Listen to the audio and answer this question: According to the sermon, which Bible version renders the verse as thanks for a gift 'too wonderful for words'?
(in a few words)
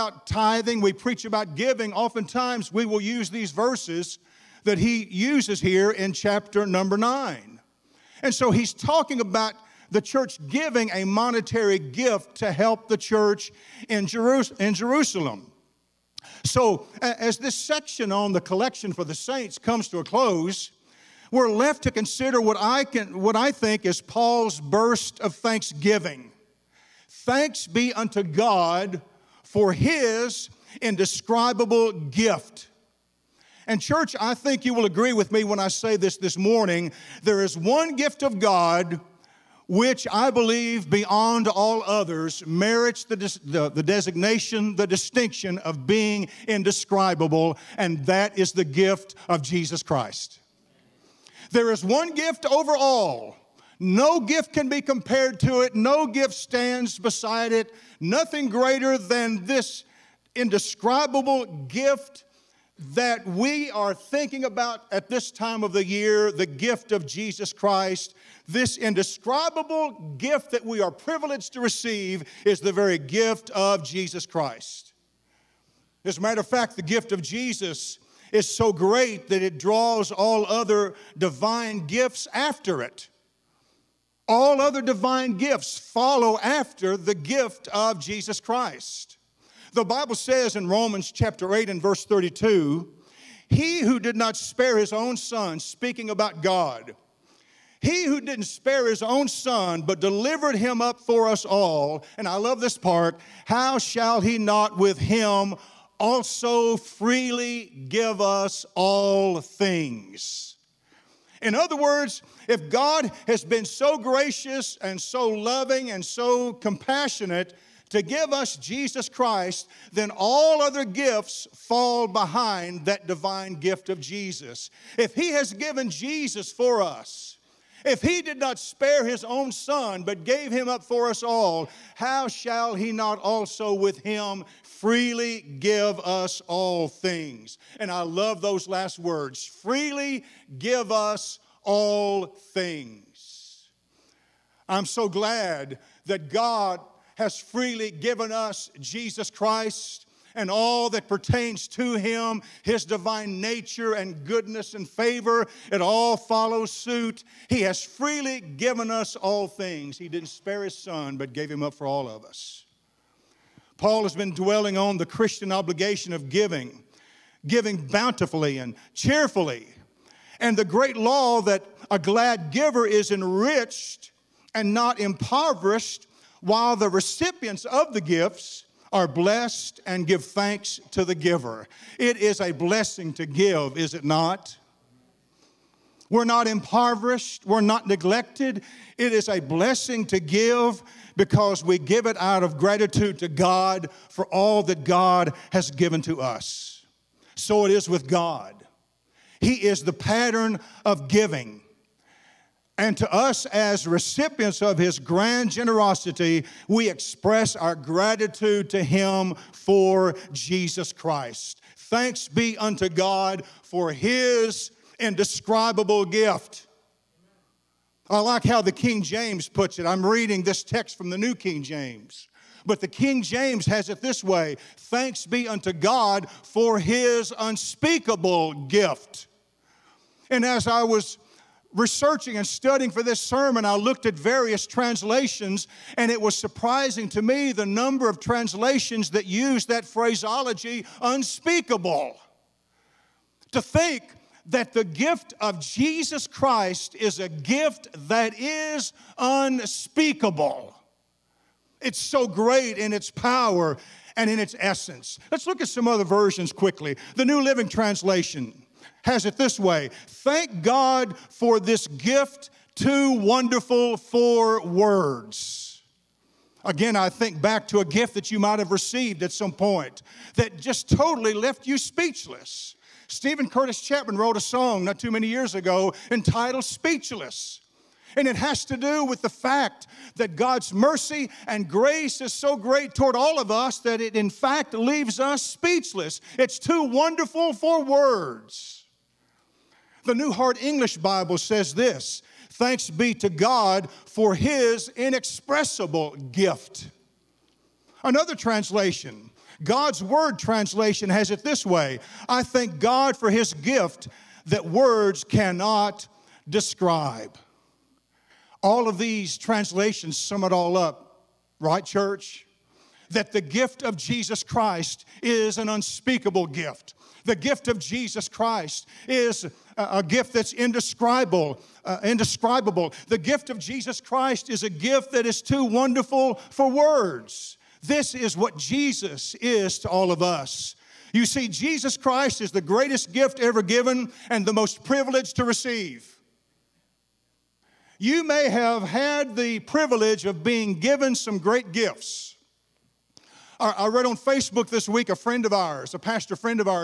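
New Living Translation.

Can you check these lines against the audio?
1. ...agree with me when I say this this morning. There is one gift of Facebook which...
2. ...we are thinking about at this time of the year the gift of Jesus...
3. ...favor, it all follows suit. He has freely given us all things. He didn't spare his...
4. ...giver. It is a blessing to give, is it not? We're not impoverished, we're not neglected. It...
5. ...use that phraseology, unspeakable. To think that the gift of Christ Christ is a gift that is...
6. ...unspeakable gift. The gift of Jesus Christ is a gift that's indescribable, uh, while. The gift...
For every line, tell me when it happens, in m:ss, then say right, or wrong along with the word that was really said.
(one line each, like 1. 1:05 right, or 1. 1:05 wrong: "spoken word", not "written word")
1. 0:34 wrong: "God", not "Facebook"
2. 1:03 right
3. 2:34 right
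4. 3:01 right
5. 3:59 wrong: "Jesus", not "Christ"
6. 5:15 wrong: "indescribable", not "while".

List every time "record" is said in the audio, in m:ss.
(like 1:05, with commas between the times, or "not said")
not said.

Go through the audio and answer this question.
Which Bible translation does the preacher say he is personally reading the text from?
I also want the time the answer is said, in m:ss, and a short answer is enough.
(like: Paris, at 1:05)
New King James, at 3:41.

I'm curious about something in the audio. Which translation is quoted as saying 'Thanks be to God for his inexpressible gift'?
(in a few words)
New Heart English Bible.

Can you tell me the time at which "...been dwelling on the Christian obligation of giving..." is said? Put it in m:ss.
2:44.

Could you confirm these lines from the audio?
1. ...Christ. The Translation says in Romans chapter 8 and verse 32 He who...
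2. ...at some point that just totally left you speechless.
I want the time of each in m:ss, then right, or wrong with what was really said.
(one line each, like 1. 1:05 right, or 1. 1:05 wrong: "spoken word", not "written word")
1. 1:28 wrong: "Bible", not "Translation"
2. 4:29 right.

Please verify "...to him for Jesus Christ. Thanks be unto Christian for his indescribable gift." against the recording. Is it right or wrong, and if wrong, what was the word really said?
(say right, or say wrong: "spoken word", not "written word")
wrong: "God", not "Christian".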